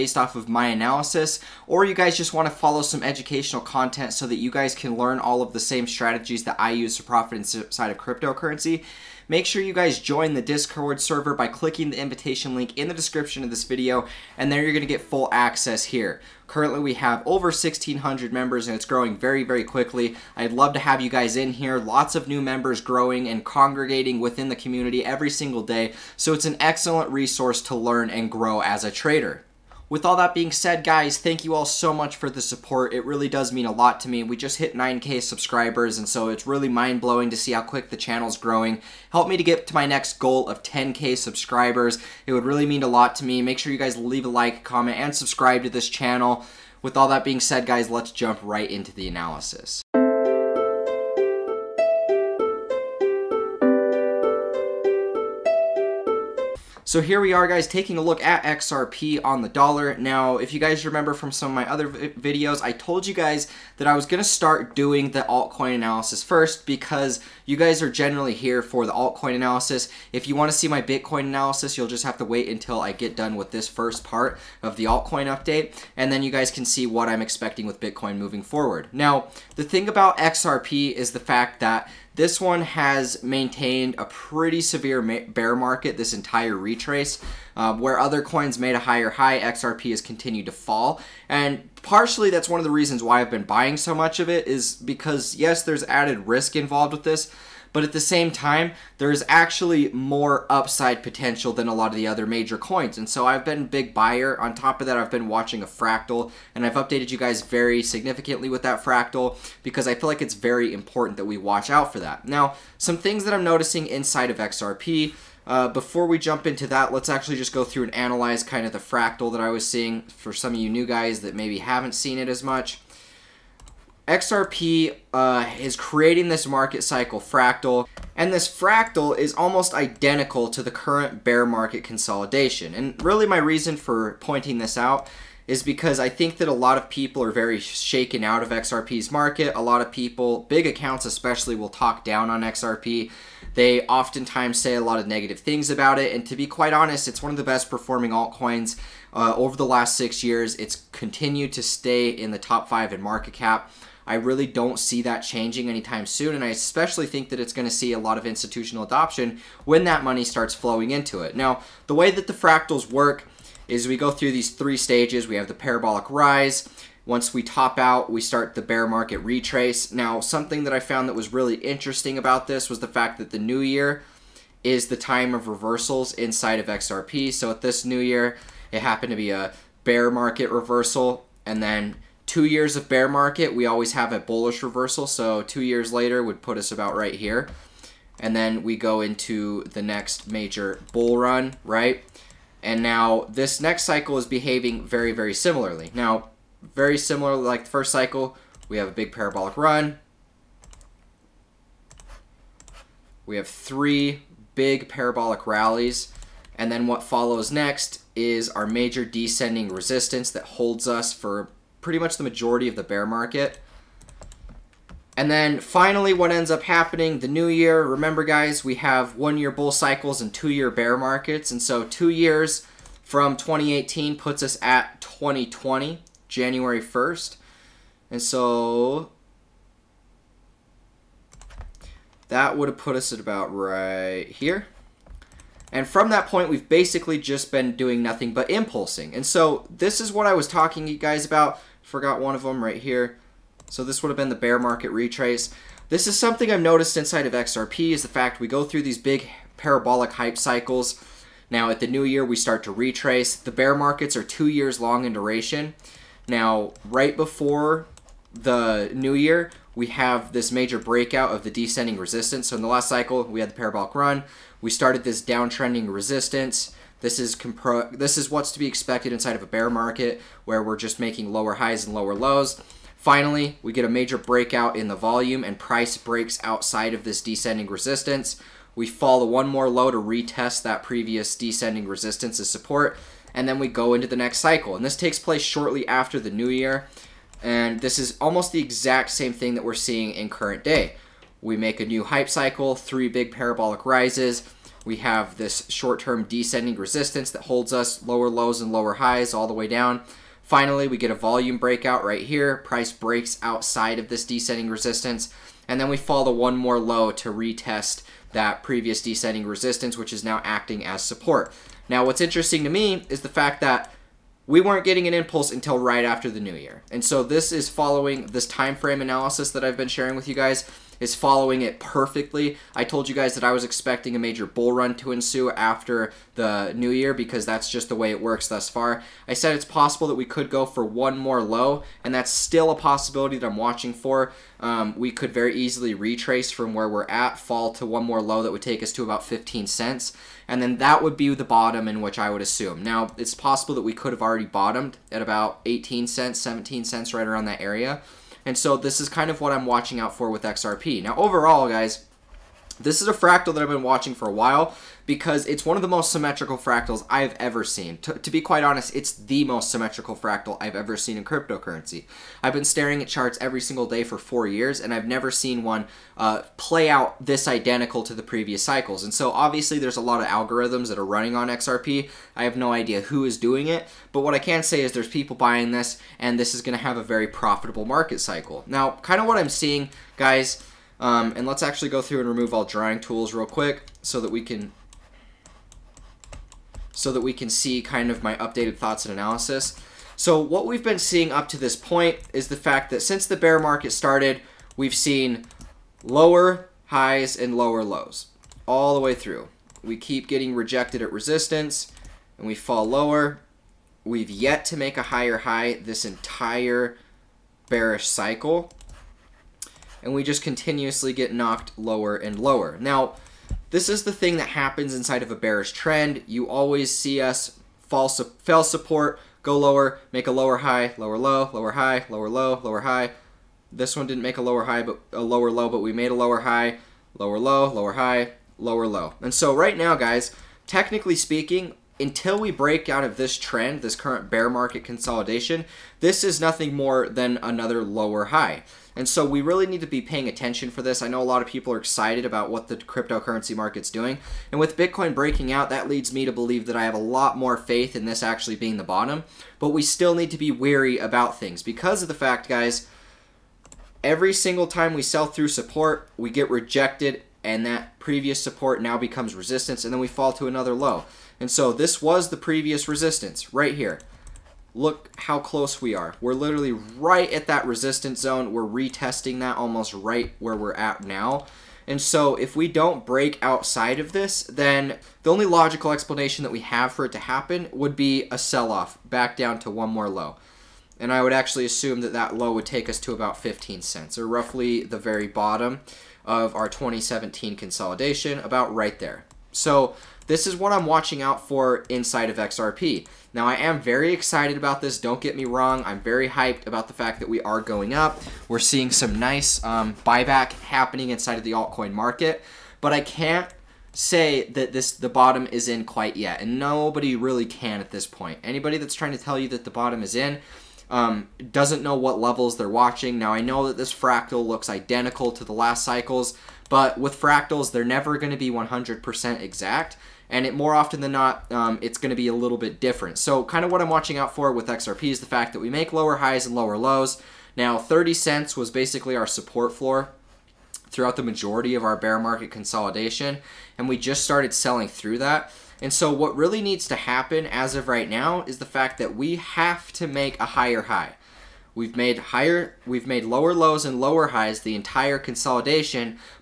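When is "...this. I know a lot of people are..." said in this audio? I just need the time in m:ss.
7:20.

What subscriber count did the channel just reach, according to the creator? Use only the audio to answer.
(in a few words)
9K.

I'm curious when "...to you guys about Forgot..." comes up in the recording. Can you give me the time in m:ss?
4:00.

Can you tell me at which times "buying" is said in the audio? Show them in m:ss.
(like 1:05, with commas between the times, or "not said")
1:33, 6:15.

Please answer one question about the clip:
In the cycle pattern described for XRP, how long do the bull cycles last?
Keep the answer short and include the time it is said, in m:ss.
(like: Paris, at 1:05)
one year, at 3:39.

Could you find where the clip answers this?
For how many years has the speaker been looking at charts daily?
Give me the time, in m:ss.
6:04.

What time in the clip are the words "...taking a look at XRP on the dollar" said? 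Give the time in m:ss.
0:57.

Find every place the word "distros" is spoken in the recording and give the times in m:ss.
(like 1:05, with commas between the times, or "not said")
not said.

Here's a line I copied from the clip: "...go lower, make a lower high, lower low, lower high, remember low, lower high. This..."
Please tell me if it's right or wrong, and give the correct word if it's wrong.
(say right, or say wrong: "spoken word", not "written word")
wrong: "lower", not "remember".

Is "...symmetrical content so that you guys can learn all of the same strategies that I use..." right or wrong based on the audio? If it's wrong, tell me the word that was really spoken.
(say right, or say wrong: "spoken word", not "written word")
wrong: "educational", not "symmetrical".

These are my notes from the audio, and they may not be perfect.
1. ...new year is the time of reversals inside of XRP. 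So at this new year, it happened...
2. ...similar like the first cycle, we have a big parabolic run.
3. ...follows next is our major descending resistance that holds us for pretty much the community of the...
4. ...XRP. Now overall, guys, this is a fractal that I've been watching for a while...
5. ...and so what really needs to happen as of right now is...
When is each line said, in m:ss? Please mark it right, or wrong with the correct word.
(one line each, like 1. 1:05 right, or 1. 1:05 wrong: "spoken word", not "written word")
1. 2:53 right
2. 3:16 right
3. 3:27 wrong: "majority", not "community"
4. 5:50 right
5. 8:55 right.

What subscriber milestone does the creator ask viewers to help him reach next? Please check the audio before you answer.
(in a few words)
10K.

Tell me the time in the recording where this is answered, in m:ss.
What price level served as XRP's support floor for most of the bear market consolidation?
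8:47.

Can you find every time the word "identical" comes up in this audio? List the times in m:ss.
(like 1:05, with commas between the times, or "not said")
2:09, 6:07, 8:34.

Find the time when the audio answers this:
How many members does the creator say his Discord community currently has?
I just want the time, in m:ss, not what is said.
0:17.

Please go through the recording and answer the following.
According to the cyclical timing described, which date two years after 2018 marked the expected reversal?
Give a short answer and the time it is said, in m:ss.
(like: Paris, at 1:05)
January 1st, 2020, at 3:45.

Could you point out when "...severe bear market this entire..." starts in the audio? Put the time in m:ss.
1:24.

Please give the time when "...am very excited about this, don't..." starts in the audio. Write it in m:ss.
8:13.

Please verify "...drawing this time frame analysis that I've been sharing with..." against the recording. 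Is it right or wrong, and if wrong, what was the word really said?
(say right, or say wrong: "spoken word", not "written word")
wrong: "following", not "drawing".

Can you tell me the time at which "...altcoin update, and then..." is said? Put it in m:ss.
1:14.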